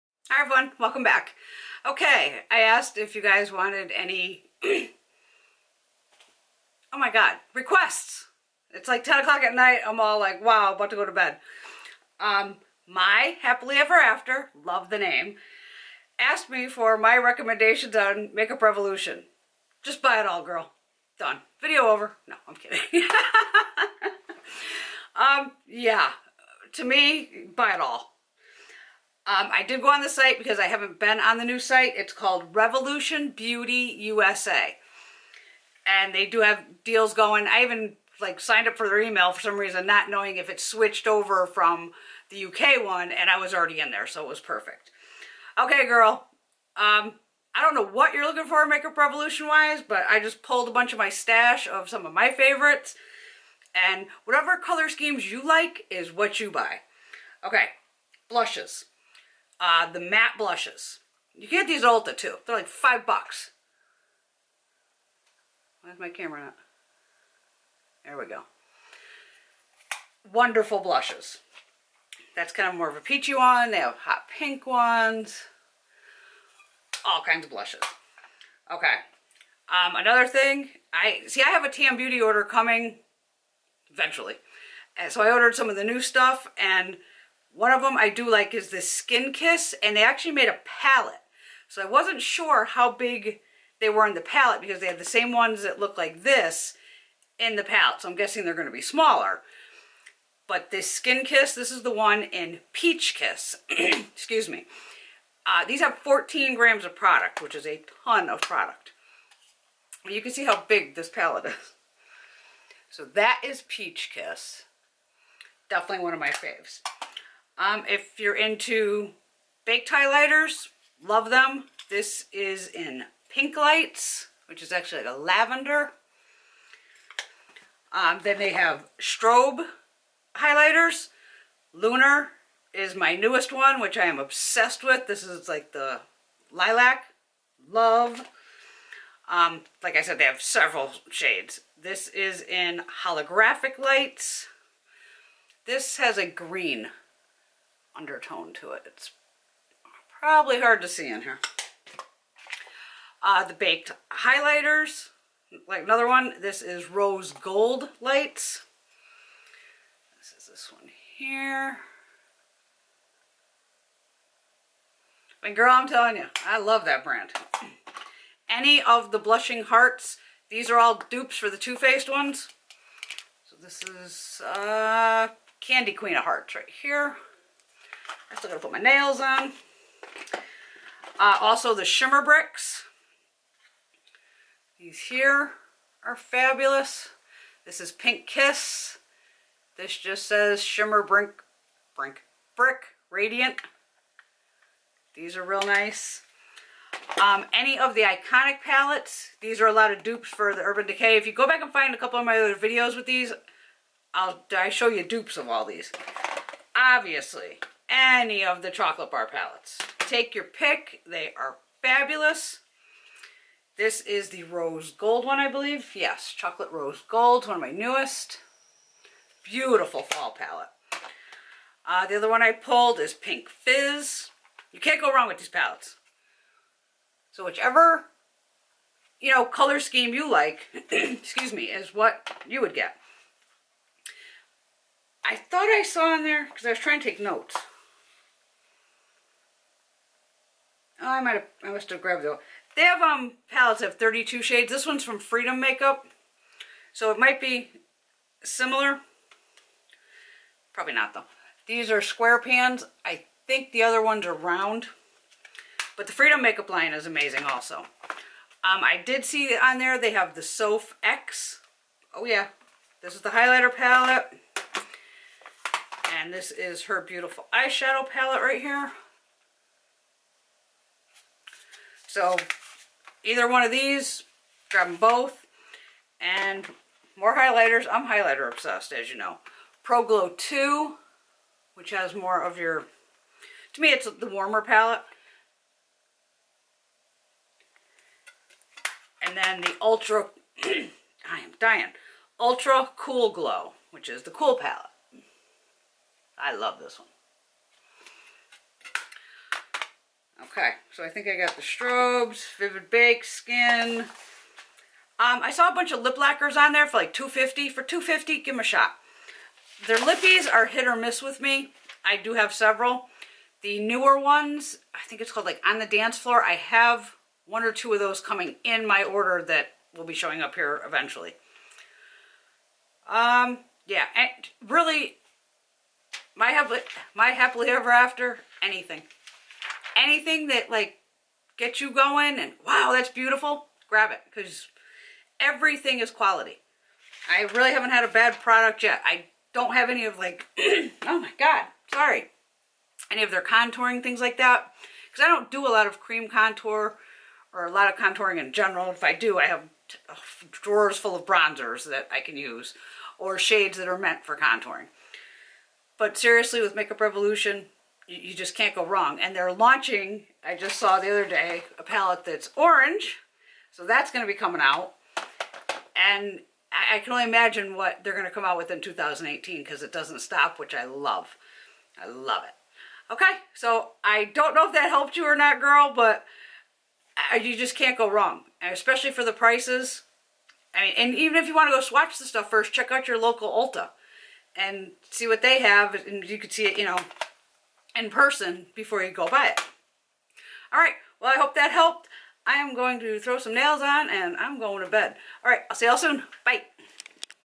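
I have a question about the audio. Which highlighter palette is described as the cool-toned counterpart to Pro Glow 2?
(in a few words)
Ultra Cool Glow.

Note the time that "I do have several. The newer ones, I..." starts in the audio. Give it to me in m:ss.
5:12.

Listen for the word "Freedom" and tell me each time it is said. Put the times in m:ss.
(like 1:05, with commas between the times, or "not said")
4:05, 4:16.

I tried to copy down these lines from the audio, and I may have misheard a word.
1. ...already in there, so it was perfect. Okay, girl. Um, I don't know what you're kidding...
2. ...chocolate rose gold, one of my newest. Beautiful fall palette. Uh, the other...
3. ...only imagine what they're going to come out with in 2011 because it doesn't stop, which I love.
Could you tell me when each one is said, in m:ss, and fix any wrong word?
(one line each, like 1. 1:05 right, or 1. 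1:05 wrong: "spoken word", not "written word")
1. 0:43 wrong: "looking", not "kidding"
2. 3:36 right
3. 6:07 wrong: "2018", not "2011".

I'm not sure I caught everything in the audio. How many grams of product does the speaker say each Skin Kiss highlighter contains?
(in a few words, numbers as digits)
14.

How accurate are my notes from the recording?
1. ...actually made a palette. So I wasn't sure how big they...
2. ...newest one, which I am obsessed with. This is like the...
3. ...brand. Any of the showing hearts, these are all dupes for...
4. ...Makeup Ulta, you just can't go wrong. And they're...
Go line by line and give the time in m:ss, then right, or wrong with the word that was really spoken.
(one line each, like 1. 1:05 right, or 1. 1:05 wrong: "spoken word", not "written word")
1. 1:30 right
2. 2:13 right
3. 2:47 wrong: "blushing", not "showing"
4. 5:56 wrong: "Revolution", not "Ulta".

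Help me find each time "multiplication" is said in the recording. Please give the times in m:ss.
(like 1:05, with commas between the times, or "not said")
not said.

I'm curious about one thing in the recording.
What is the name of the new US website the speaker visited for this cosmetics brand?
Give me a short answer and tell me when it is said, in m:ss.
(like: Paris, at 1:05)
Revolution Beauty USA, at 0:32.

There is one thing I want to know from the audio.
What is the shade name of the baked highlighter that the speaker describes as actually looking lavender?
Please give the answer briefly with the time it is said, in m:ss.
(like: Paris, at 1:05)
Pink Lights, at 2:03.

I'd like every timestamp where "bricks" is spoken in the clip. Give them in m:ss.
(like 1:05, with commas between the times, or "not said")
3:02, 3:12.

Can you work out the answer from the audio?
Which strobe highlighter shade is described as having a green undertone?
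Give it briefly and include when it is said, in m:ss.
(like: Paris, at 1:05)
Holographic Lights, at 2:23.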